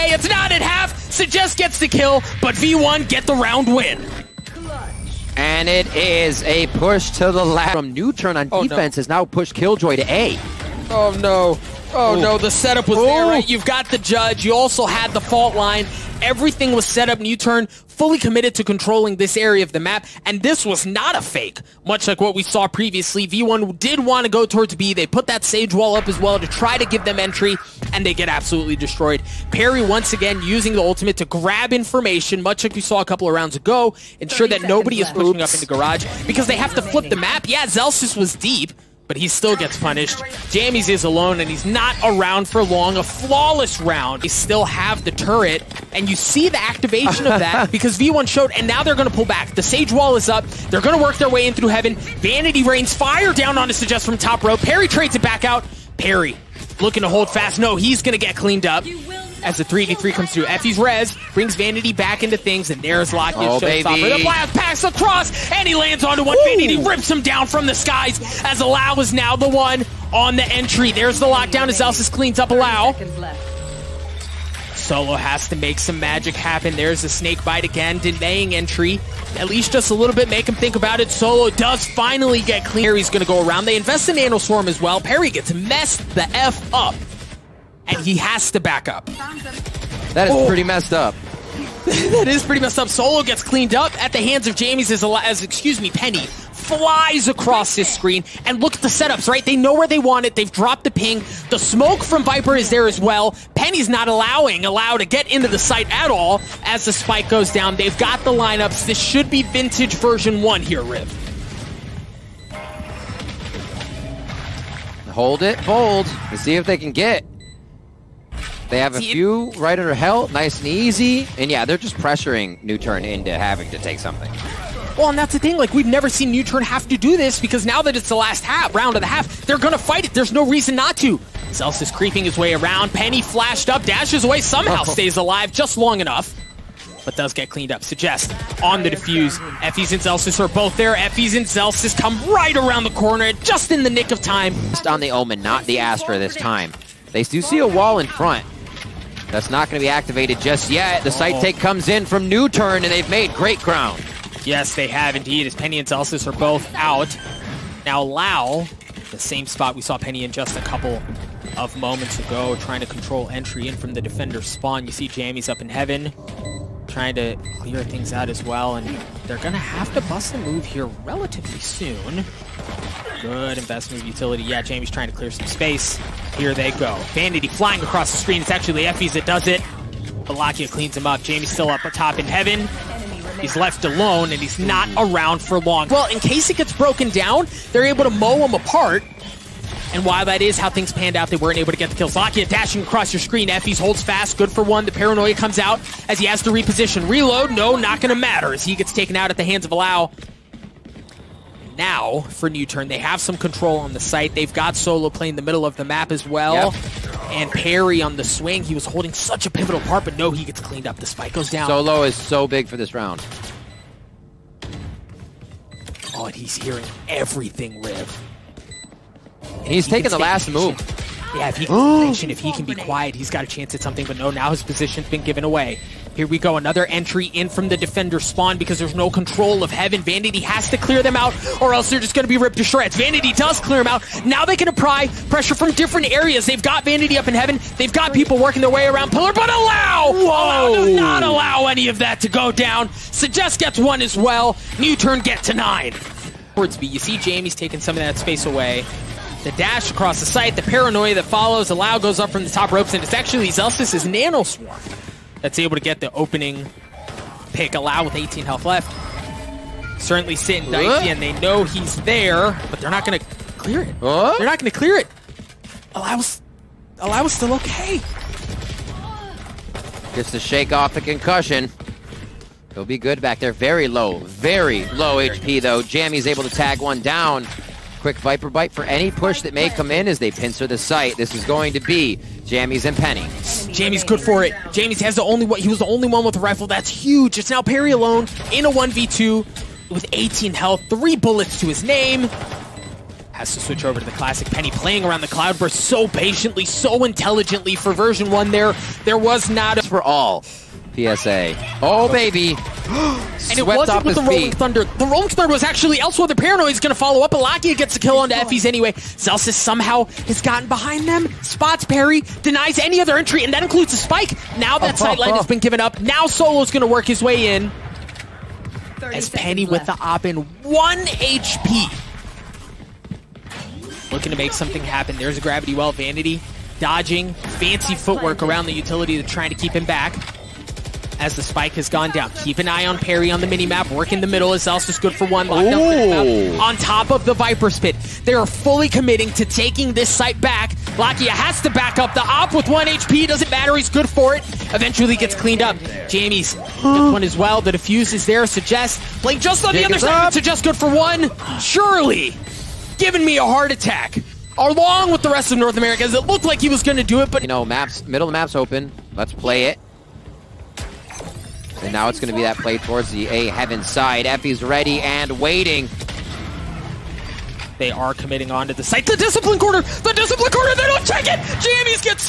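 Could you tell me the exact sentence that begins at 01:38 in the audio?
And look at the setups, right?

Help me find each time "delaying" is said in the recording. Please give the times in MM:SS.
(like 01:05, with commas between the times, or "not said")
01:17.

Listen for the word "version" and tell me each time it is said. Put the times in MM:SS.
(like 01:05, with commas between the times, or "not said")
01:49, 04:57.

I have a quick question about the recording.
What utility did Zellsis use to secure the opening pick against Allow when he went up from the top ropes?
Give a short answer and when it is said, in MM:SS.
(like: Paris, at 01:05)
Nano swarm, at 04:14.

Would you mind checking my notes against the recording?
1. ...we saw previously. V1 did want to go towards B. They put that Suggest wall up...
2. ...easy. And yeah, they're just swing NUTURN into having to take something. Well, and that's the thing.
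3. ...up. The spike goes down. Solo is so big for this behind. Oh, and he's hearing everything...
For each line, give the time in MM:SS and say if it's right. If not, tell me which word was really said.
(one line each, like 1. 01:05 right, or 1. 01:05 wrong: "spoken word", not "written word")
1. 00:22 wrong: "Sage", not "Suggest"
2. 02:00 wrong: "pressuring", not "swing"
3. 03:30 wrong: "round", not "behind".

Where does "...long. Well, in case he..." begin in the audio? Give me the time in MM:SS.
03:05.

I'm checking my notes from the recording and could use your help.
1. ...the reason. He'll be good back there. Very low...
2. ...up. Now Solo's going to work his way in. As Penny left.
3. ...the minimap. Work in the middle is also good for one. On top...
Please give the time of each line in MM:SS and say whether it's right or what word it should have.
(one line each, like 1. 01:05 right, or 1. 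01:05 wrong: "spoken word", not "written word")
1. 04:30 wrong: "concussion", not "reason"
2. 05:15 right
3. 05:33 right.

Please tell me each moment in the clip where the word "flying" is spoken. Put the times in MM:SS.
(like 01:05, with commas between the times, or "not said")
02:57.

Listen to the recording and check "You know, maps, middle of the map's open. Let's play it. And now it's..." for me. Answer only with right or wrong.
right.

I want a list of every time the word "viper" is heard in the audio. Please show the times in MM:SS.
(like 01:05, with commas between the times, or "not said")
01:42, 04:38, 05:37.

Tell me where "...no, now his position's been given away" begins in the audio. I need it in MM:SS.
03:44.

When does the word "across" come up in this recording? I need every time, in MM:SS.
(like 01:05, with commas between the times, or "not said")
01:04, 01:37, 02:57, 03:12, 04:09.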